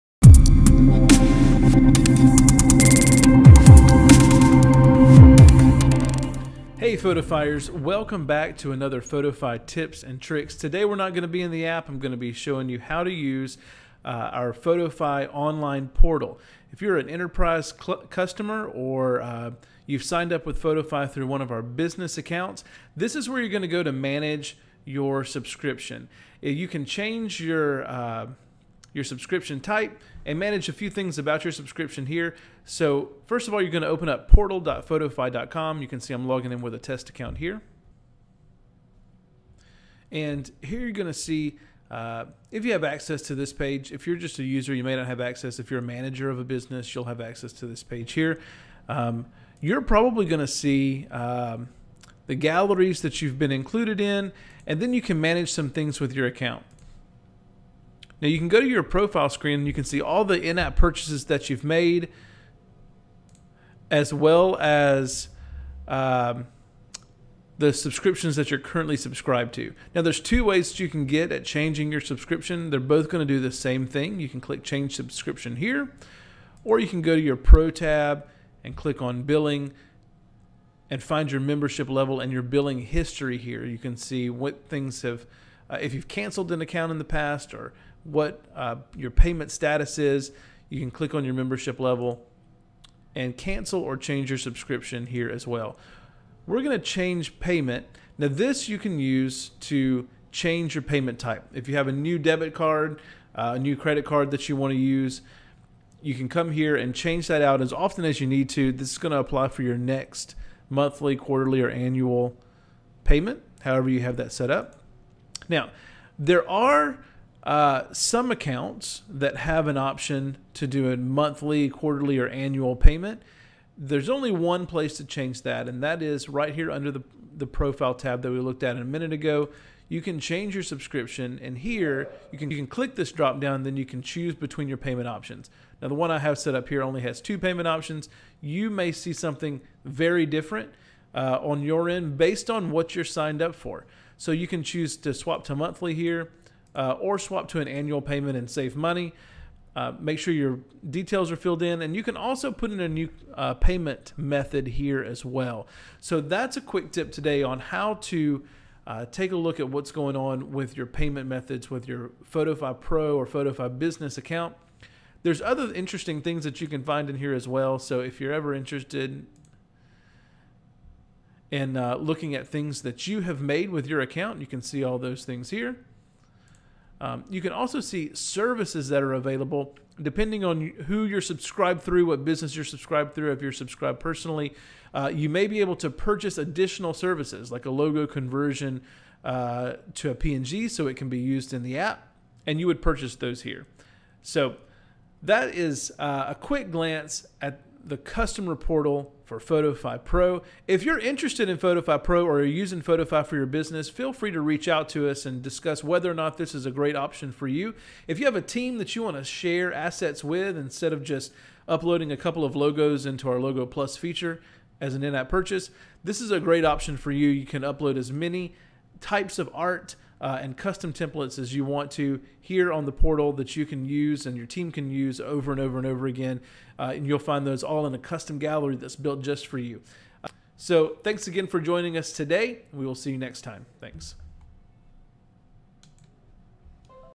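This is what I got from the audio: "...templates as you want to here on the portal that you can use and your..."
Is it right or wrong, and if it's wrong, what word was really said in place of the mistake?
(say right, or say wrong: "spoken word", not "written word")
right.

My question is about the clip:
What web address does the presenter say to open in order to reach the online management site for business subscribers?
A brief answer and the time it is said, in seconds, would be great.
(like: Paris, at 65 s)
portal.photofy.com, at 34 s.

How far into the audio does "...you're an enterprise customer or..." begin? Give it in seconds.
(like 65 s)
16 s.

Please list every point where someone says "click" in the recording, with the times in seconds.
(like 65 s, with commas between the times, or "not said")
74 s, 78 s, 90 s, 132 s.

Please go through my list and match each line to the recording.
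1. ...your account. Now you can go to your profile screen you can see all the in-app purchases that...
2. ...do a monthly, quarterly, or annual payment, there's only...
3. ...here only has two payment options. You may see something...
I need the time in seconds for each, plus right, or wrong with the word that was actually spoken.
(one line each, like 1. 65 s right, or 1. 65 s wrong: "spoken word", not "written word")
1. 56 s right
2. 120 s right
3. 136 s right.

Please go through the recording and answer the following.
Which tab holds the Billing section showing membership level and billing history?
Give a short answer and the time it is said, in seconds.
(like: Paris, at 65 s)
Pro tab, at 77 s.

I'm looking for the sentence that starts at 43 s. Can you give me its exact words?
If you're just a user, you may not have access.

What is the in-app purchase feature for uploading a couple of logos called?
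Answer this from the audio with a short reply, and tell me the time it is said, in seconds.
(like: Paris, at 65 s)
Logo Plus, at 213 s.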